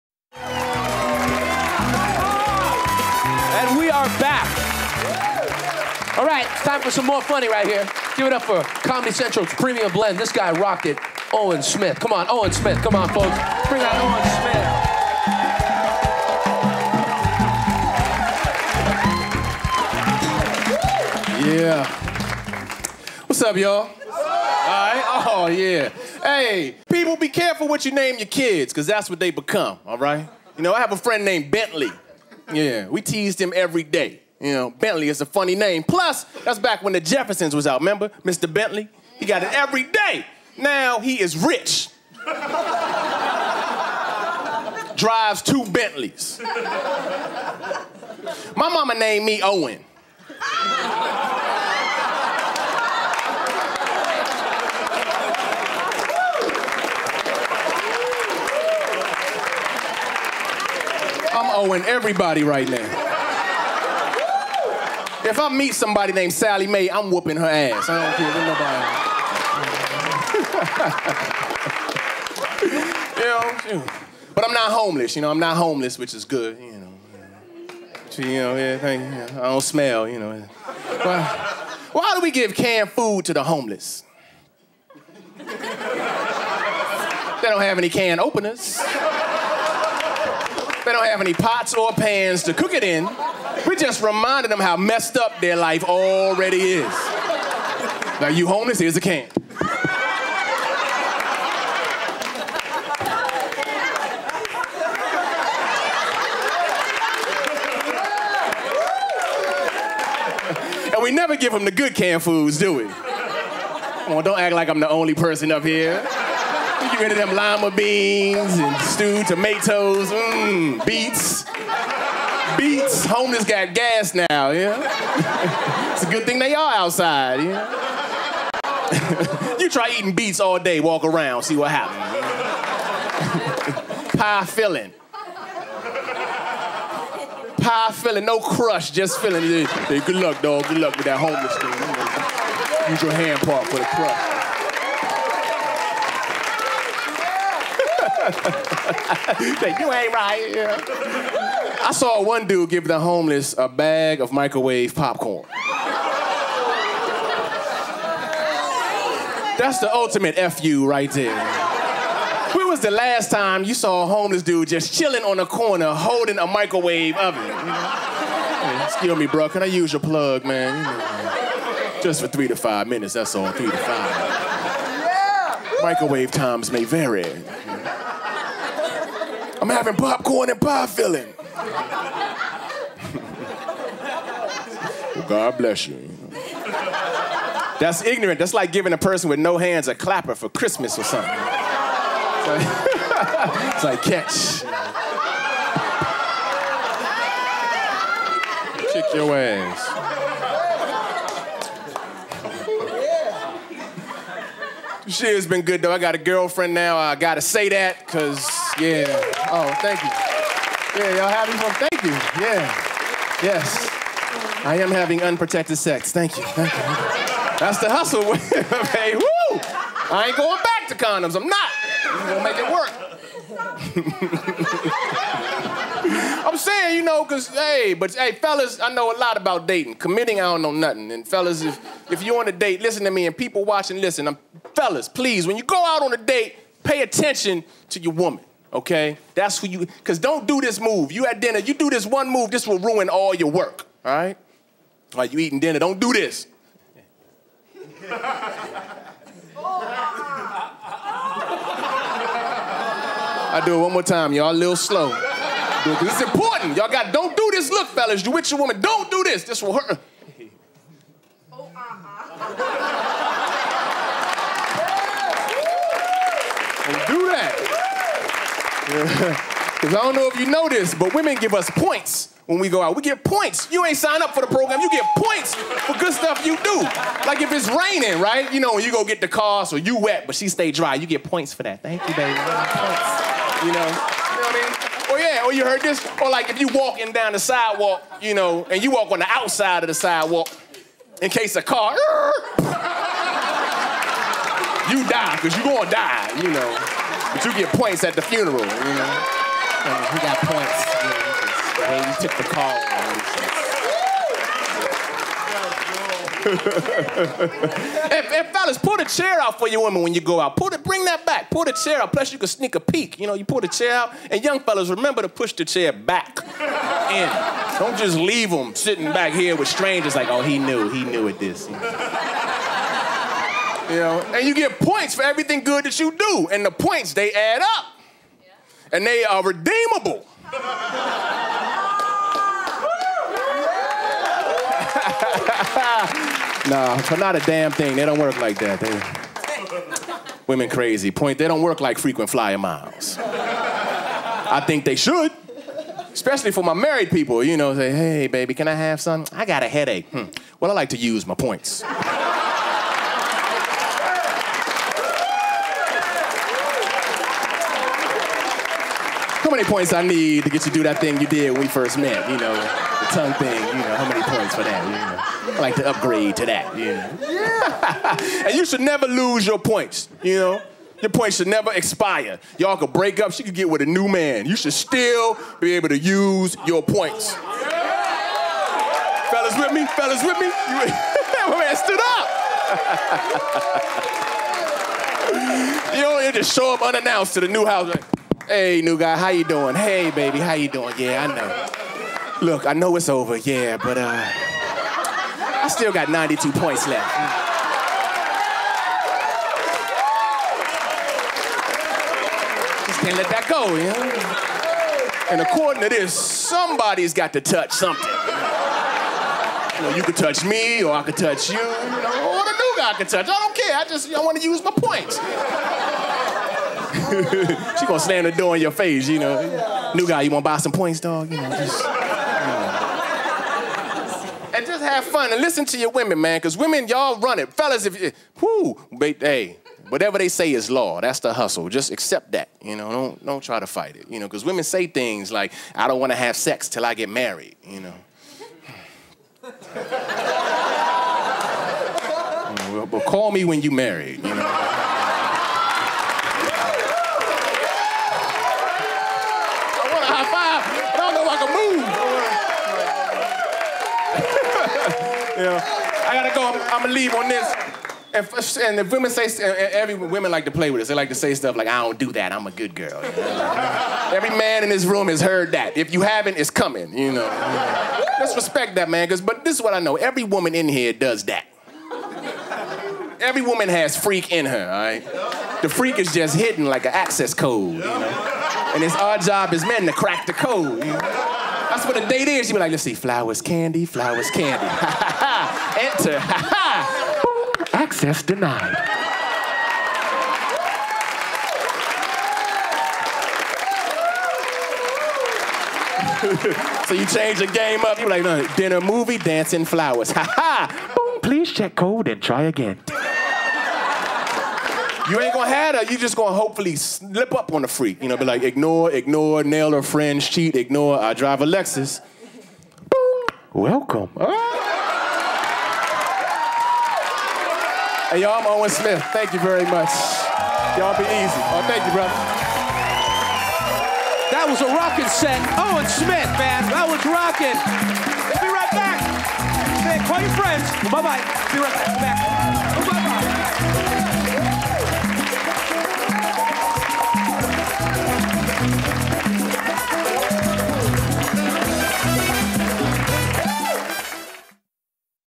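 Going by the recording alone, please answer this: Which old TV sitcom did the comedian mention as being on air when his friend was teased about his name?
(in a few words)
The Jeffersons.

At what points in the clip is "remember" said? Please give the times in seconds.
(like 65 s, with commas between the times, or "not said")
37 s, 314 s.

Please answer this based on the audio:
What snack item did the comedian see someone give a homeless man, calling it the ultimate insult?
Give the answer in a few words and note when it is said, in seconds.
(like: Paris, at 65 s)
microwave popcorn, at 154 s.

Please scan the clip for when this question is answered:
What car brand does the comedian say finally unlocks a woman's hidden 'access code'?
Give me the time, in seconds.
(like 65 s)
511 s.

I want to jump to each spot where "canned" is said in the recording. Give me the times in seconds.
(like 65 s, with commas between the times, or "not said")
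82 s, 111 s.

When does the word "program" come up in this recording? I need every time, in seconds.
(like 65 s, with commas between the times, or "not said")
274 s.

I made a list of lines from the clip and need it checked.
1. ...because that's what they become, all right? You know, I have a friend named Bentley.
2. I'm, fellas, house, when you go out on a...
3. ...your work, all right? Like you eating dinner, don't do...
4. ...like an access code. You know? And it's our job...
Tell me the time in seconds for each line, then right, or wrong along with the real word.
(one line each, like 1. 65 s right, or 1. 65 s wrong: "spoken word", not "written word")
1. 28 s right
2. 234 s wrong: "please", not "house"
3. 243 s right
4. 476 s right.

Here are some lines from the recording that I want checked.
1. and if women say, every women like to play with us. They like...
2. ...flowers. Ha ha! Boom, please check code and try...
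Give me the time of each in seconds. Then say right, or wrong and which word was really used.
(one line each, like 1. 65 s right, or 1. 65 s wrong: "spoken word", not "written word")
1. 458 s right
2. 499 s right.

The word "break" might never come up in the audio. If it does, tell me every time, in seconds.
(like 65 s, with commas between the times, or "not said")
372 s.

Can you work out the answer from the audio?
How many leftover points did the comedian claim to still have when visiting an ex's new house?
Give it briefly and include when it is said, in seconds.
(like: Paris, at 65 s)
92, at 396 s.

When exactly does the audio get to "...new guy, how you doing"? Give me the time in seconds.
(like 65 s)
388 s.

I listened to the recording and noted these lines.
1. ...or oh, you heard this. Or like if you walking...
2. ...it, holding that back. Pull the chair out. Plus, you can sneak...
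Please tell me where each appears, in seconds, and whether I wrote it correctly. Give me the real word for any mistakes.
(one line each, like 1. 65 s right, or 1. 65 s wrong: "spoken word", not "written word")
1. 285 s right
2. 310 s wrong: "bring", not "holding".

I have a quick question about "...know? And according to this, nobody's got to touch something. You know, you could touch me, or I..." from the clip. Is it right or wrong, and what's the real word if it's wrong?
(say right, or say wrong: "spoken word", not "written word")
wrong: "somebody", not "nobody".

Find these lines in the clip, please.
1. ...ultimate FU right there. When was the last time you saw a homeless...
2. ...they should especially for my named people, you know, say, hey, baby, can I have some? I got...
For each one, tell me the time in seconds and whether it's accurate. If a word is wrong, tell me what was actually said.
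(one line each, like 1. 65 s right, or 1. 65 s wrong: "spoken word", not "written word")
1. 159 s right
2. 344 s wrong: "married", not "named".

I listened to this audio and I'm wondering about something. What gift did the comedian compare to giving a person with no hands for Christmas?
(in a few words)
a clapper.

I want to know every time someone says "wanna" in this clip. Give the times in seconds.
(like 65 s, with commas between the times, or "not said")
420 s.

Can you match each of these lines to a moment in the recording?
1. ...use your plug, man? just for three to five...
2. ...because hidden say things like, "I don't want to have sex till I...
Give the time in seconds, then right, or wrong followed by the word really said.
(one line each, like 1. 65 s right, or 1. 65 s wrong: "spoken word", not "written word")
1. 169 s right
2. 434 s wrong: "women", not "hidden".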